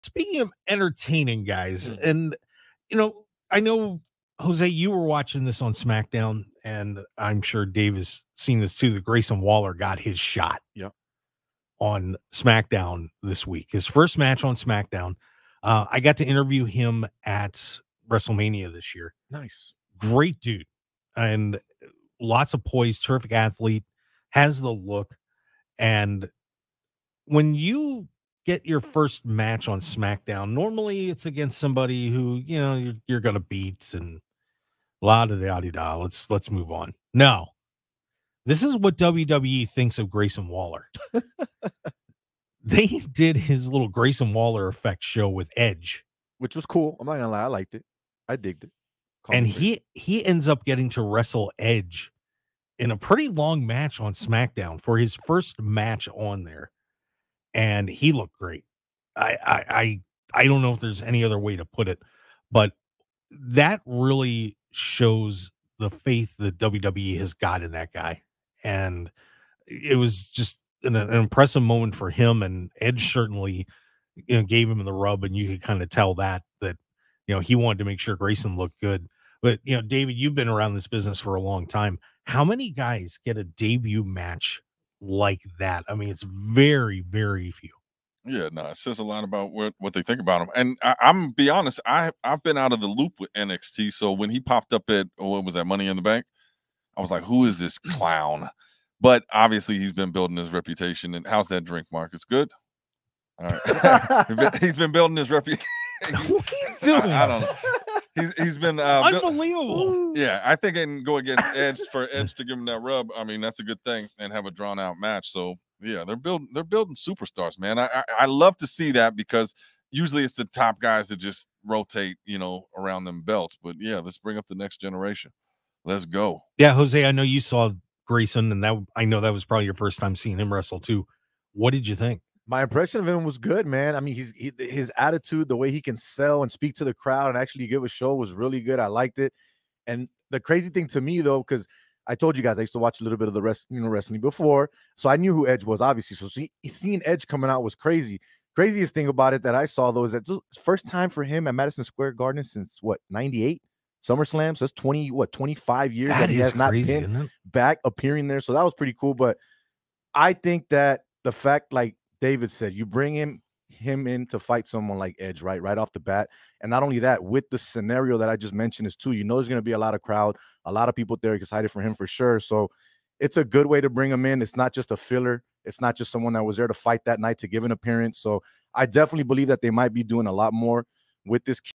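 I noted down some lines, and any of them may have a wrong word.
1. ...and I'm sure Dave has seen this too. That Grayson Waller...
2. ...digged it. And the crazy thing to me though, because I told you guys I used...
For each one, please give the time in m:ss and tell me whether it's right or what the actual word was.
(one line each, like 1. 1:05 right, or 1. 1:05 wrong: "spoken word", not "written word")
1. 0:06 right
2. 2:18 wrong: "liked", not "digged".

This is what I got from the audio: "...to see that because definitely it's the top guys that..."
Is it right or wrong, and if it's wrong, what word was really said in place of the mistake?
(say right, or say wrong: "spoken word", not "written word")
wrong: "usually", not "definitely".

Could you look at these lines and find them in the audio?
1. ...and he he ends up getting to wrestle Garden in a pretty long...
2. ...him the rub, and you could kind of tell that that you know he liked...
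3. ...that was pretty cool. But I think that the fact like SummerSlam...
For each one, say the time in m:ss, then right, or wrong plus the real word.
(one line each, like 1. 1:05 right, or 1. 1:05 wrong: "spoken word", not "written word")
1. 0:49 wrong: "Edge", not "Garden"
2. 1:14 wrong: "wanted", not "liked"
3. 2:38 wrong: "David", not "SummerSlam".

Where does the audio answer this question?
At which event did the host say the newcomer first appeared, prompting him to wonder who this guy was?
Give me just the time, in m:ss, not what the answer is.
1:35.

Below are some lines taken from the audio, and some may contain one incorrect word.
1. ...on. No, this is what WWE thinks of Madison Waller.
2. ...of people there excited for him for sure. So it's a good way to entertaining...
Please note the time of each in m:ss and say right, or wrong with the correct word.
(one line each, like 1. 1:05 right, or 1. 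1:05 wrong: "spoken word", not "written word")
1. 0:36 wrong: "Grayson", not "Madison"
2. 2:50 wrong: "bring", not "entertaining".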